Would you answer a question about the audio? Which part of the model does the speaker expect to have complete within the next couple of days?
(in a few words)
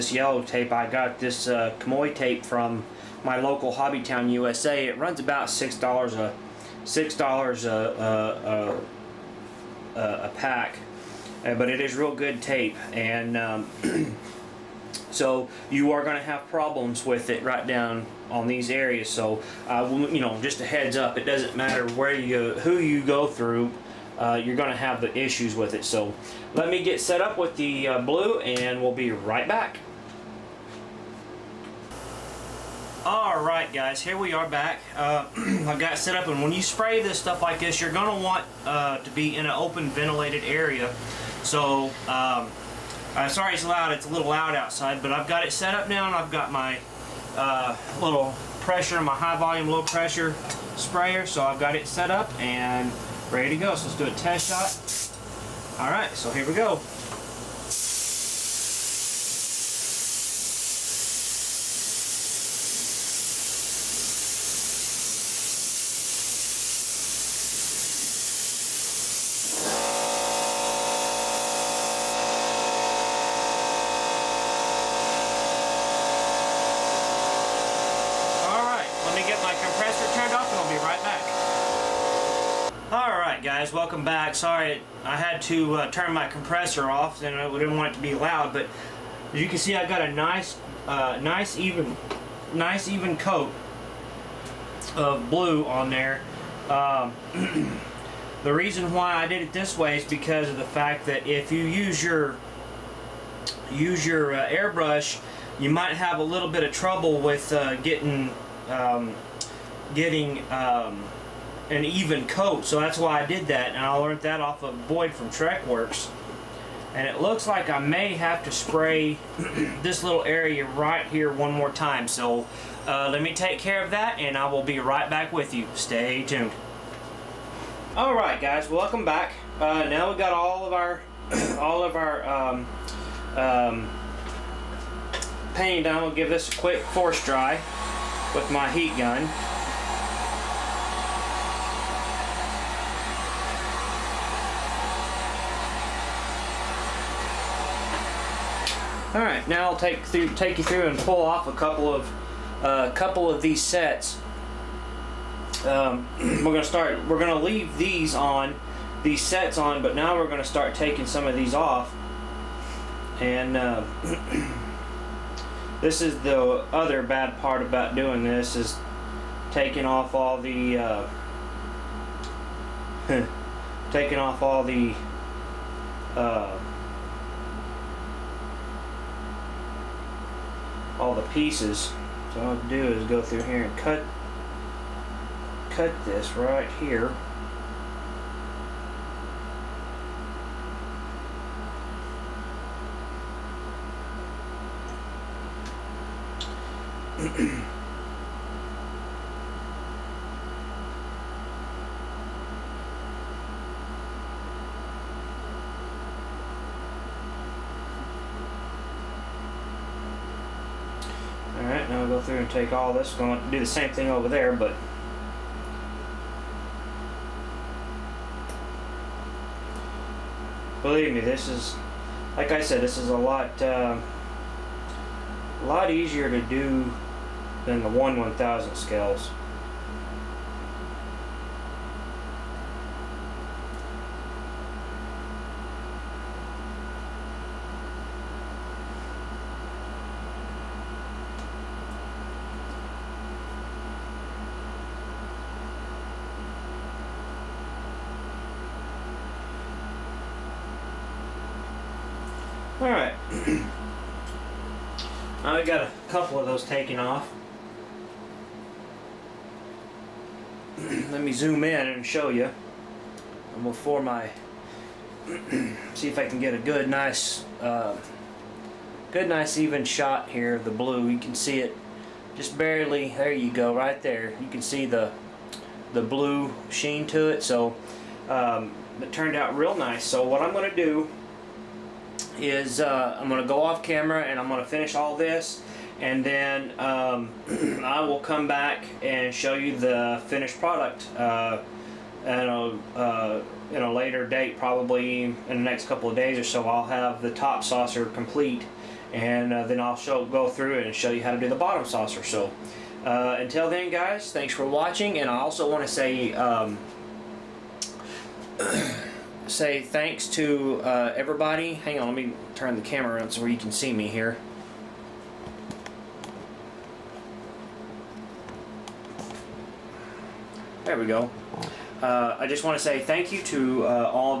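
Top saucer.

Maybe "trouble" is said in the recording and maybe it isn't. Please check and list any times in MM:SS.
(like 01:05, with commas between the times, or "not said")
01:46.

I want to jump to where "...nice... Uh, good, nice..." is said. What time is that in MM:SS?
04:26.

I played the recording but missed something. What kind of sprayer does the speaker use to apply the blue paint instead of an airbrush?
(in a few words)
High volume, low pressure sprayer.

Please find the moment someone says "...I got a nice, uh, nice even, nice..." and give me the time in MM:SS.
01:29.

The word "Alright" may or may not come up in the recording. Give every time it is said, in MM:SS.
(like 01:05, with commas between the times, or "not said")
00:33, 02:07, 04:12.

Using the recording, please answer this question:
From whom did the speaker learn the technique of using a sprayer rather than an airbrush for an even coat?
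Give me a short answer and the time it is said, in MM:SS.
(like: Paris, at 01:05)
Boyd from Trekworks, at 01:54.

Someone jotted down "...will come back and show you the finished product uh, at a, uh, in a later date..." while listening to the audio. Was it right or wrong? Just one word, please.
right.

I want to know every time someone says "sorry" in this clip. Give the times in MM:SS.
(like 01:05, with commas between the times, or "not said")
00:43, 01:24.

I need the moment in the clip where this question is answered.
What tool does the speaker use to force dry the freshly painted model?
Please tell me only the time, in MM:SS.
02:18.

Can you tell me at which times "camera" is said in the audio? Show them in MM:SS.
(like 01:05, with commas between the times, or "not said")
04:43, 05:12.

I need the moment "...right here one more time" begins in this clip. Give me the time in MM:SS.
02:00.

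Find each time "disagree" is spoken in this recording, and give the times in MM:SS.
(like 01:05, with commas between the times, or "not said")
not said.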